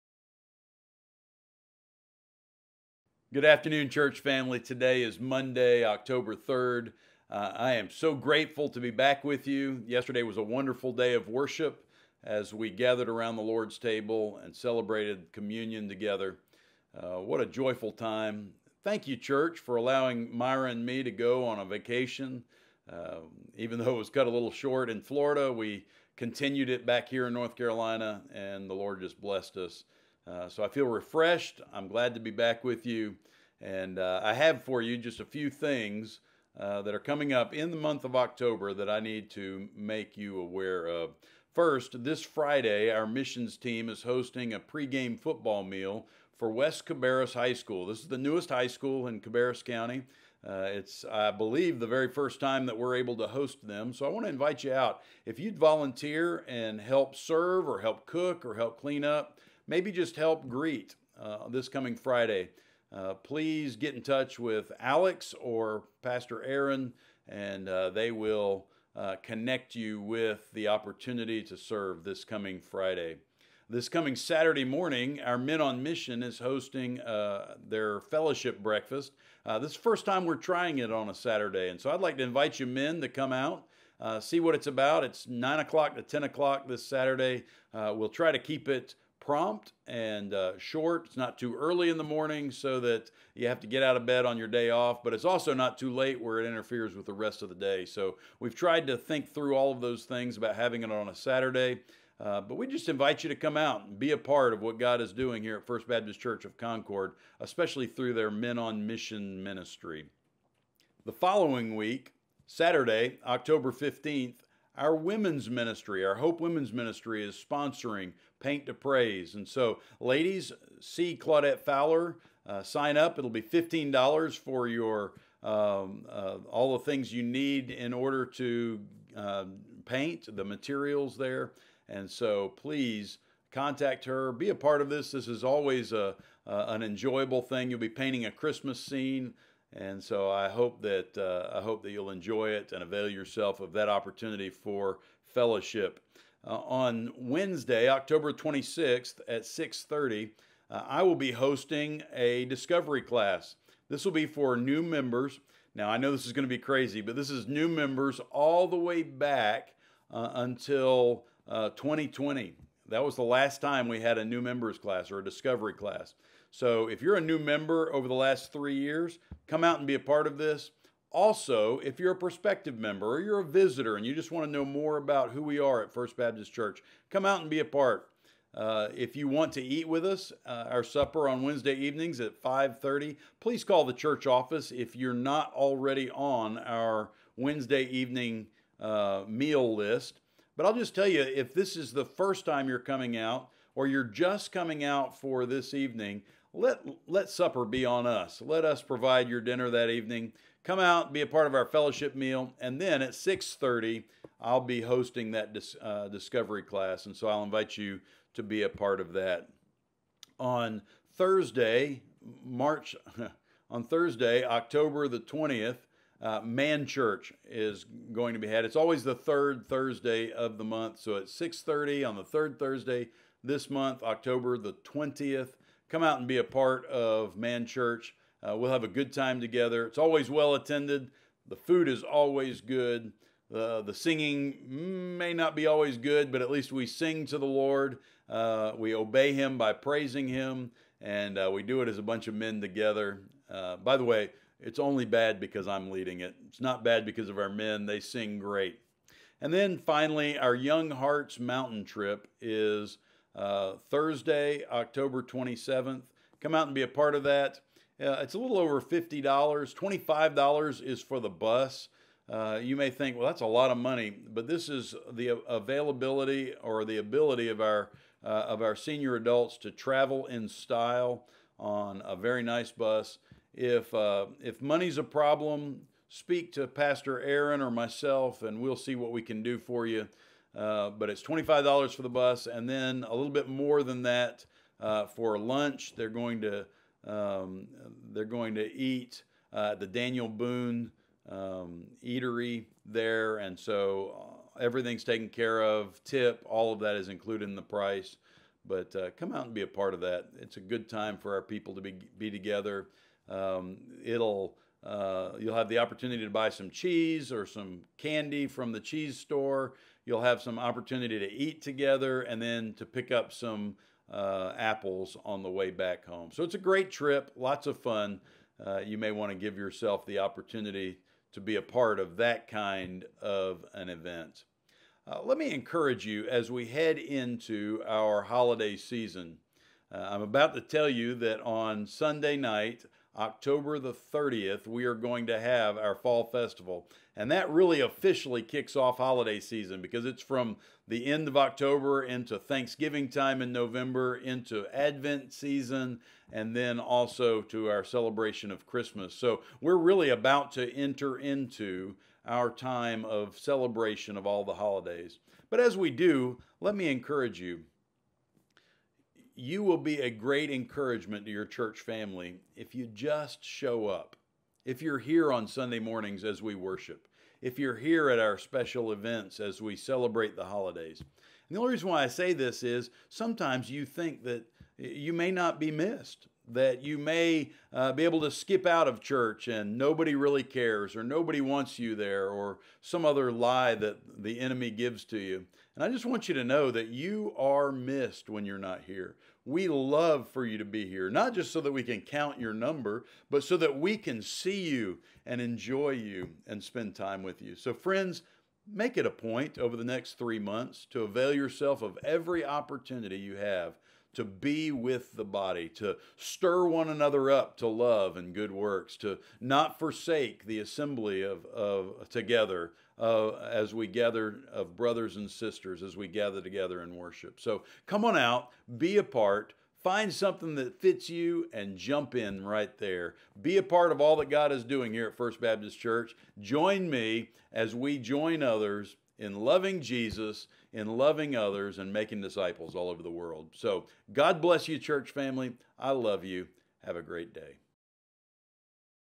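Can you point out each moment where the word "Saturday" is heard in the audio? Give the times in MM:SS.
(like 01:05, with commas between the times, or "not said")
01:14, 01:21, 01:26, 01:41, 01:52.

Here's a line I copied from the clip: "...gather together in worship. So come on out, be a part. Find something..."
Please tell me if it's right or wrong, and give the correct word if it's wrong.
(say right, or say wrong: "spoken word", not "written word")
right.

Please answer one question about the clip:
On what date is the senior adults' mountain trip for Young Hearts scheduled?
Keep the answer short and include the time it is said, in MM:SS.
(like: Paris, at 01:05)
October 27th, at 04:13.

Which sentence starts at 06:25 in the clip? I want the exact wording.
And I just want you to know that you are missed when you're not here.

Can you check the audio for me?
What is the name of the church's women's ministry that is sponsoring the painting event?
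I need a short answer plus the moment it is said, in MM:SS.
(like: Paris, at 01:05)
Hope Women's Ministry, at 01:56.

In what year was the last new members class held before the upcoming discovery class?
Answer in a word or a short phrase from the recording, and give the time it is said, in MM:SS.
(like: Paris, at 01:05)
2020, at 02:41.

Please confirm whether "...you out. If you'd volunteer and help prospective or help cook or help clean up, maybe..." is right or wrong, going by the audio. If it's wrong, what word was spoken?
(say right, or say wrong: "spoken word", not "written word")
wrong: "serve", not "prospective".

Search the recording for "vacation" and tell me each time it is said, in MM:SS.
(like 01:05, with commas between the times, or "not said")
00:21.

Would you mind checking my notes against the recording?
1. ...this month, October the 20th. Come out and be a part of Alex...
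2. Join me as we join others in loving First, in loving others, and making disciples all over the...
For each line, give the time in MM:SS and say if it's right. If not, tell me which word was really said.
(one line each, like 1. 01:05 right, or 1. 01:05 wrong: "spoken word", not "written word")
1. 03:43 wrong: "Man", not "Alex"
2. 07:06 wrong: "Jesus", not "First".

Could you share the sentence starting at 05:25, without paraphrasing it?
Uh, let me encourage you as we head into our holiday season.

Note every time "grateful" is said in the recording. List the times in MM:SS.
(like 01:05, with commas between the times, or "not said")
00:08.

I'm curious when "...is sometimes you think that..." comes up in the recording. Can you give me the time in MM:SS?
06:12.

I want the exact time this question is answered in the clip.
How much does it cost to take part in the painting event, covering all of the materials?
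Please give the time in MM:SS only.
02:03.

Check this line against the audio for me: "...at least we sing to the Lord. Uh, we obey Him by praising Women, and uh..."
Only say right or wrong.
wrong.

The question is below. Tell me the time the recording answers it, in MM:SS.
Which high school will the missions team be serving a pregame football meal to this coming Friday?
00:46.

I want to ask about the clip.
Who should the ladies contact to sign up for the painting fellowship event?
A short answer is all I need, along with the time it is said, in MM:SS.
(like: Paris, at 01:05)
Claudette Fowler, at 02:01.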